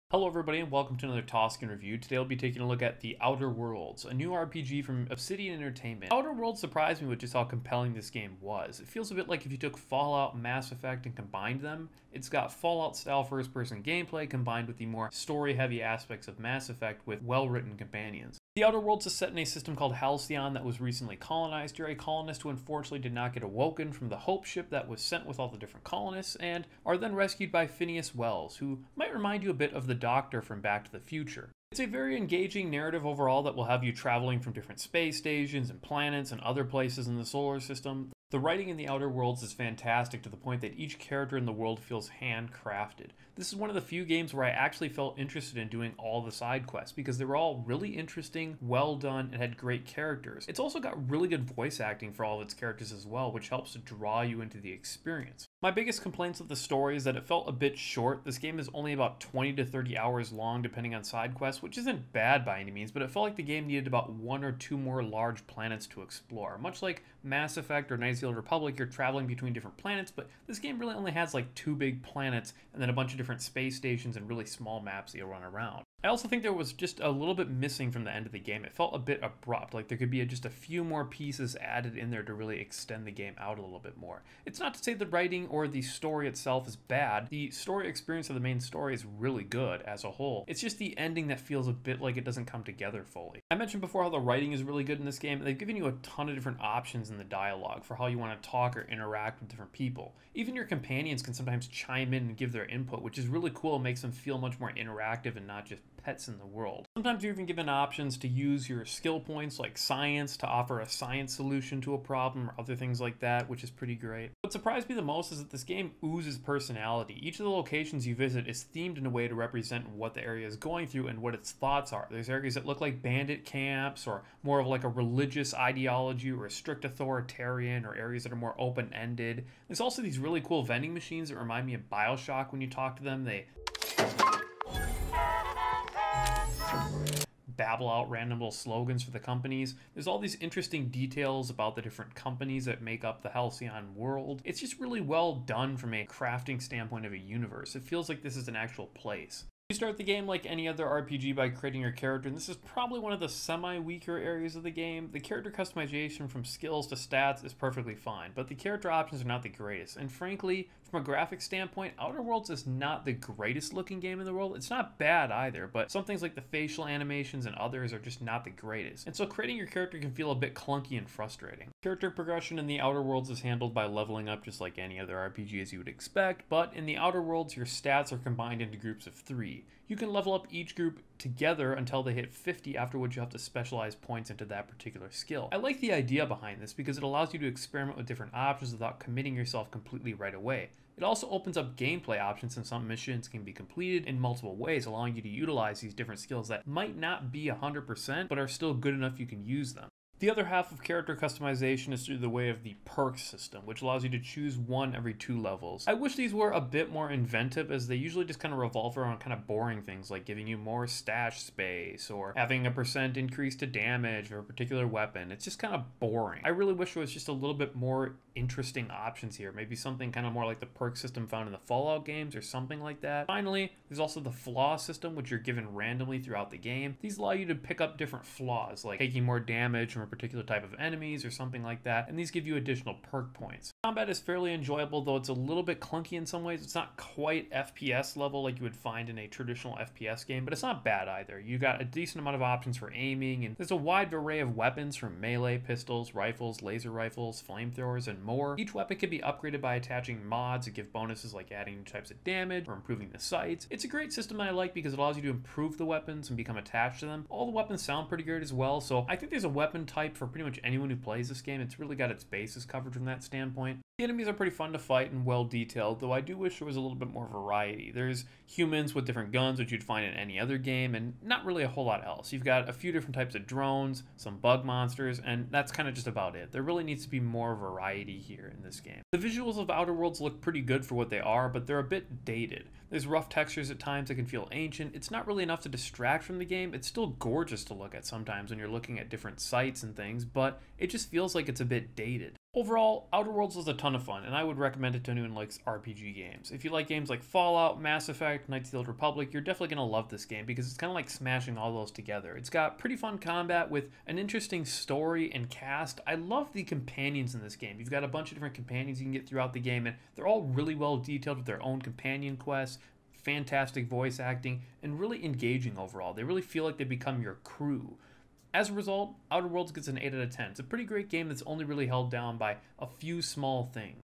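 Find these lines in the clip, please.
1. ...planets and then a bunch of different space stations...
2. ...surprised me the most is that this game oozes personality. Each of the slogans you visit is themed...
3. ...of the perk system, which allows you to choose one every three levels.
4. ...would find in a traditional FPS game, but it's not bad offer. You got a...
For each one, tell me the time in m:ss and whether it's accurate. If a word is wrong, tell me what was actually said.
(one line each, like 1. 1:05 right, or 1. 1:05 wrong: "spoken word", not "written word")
1. 1:12 right
2. 1:54 wrong: "locations", not "slogans"
3. 3:22 wrong: "two", not "three"
4. 3:58 wrong: "either", not "offer".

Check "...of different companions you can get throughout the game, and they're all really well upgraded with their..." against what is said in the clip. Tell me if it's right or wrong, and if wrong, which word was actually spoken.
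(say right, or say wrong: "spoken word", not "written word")
wrong: "detailed", not "upgraded".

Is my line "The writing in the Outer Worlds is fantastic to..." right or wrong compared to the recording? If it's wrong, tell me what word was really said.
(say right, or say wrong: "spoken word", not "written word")
right.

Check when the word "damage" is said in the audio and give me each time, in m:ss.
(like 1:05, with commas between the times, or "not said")
3:33, 3:49, 4:12.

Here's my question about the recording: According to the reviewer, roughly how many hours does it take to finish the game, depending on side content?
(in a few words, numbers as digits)
20 to 30 hours.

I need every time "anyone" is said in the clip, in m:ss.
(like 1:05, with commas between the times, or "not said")
4:20, 4:55.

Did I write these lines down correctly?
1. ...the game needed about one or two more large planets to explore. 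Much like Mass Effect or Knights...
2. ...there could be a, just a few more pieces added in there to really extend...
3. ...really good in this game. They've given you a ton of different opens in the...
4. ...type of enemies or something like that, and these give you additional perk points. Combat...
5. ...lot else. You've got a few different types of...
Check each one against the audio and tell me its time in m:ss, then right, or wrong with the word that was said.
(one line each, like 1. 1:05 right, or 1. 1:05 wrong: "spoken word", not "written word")
1. 1:03 right
2. 1:19 right
3. 1:34 wrong: "options", not "opens"
4. 3:50 right
5. 4:31 right.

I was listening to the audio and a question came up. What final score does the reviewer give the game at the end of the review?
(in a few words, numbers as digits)
8 out of 10.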